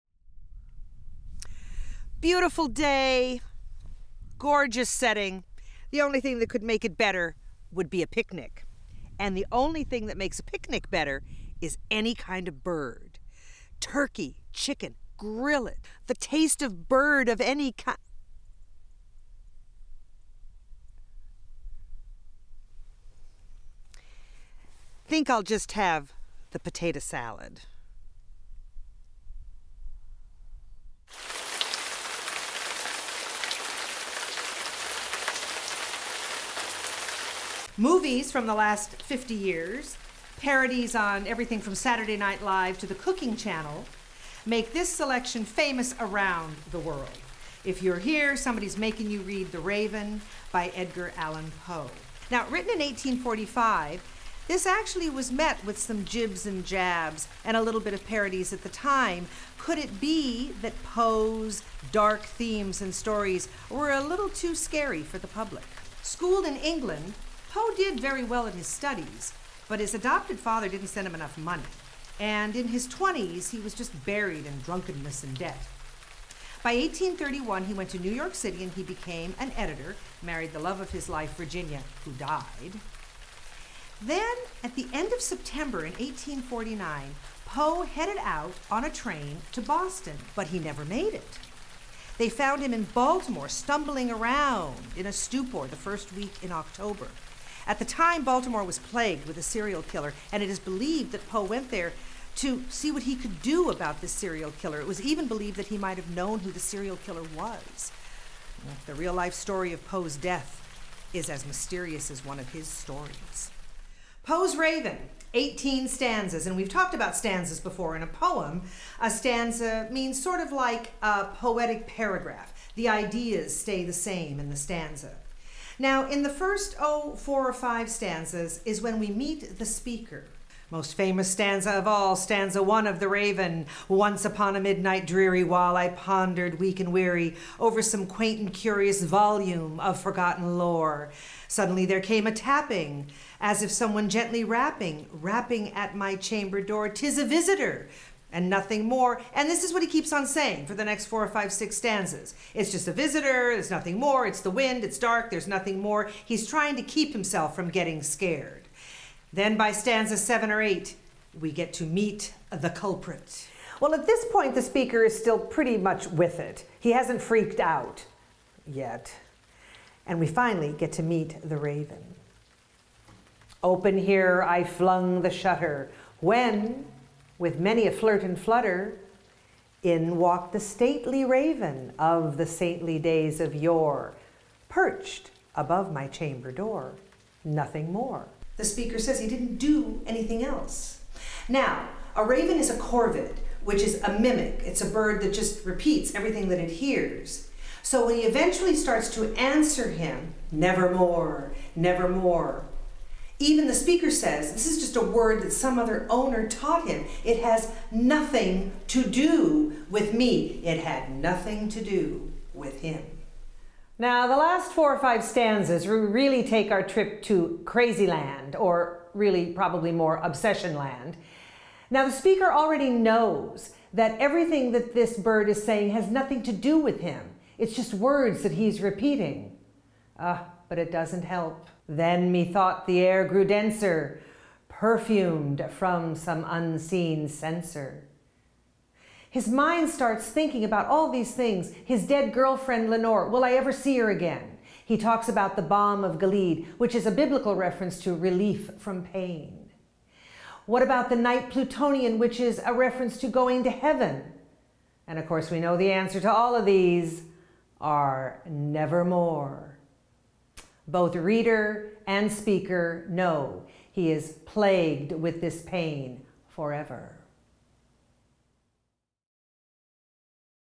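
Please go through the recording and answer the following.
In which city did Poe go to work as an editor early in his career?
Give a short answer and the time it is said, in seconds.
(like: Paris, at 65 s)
New York City, at 77 s.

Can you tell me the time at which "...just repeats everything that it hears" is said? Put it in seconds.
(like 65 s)
195 s.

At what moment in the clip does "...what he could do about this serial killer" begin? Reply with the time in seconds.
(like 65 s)
102 s.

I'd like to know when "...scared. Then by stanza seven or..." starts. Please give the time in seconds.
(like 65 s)
158 s.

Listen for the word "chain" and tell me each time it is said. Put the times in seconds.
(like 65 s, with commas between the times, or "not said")
not said.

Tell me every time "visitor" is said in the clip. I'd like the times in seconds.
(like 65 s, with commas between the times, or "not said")
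147 s, 152 s.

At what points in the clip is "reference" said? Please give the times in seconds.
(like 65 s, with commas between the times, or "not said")
247 s, 252 s.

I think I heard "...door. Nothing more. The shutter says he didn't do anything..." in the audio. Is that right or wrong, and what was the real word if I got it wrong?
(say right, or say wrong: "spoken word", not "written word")
wrong: "speaker", not "shutter".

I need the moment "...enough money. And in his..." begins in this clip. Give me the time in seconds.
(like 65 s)
71 s.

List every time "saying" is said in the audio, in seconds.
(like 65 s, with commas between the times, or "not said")
150 s, 225 s.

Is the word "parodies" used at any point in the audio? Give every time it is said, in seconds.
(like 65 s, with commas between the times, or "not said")
40 s, 58 s.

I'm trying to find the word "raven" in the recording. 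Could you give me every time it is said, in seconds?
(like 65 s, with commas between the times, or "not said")
49 s, 114 s, 133 s, 171 s, 181 s, 192 s.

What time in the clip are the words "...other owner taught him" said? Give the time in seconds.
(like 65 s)
205 s.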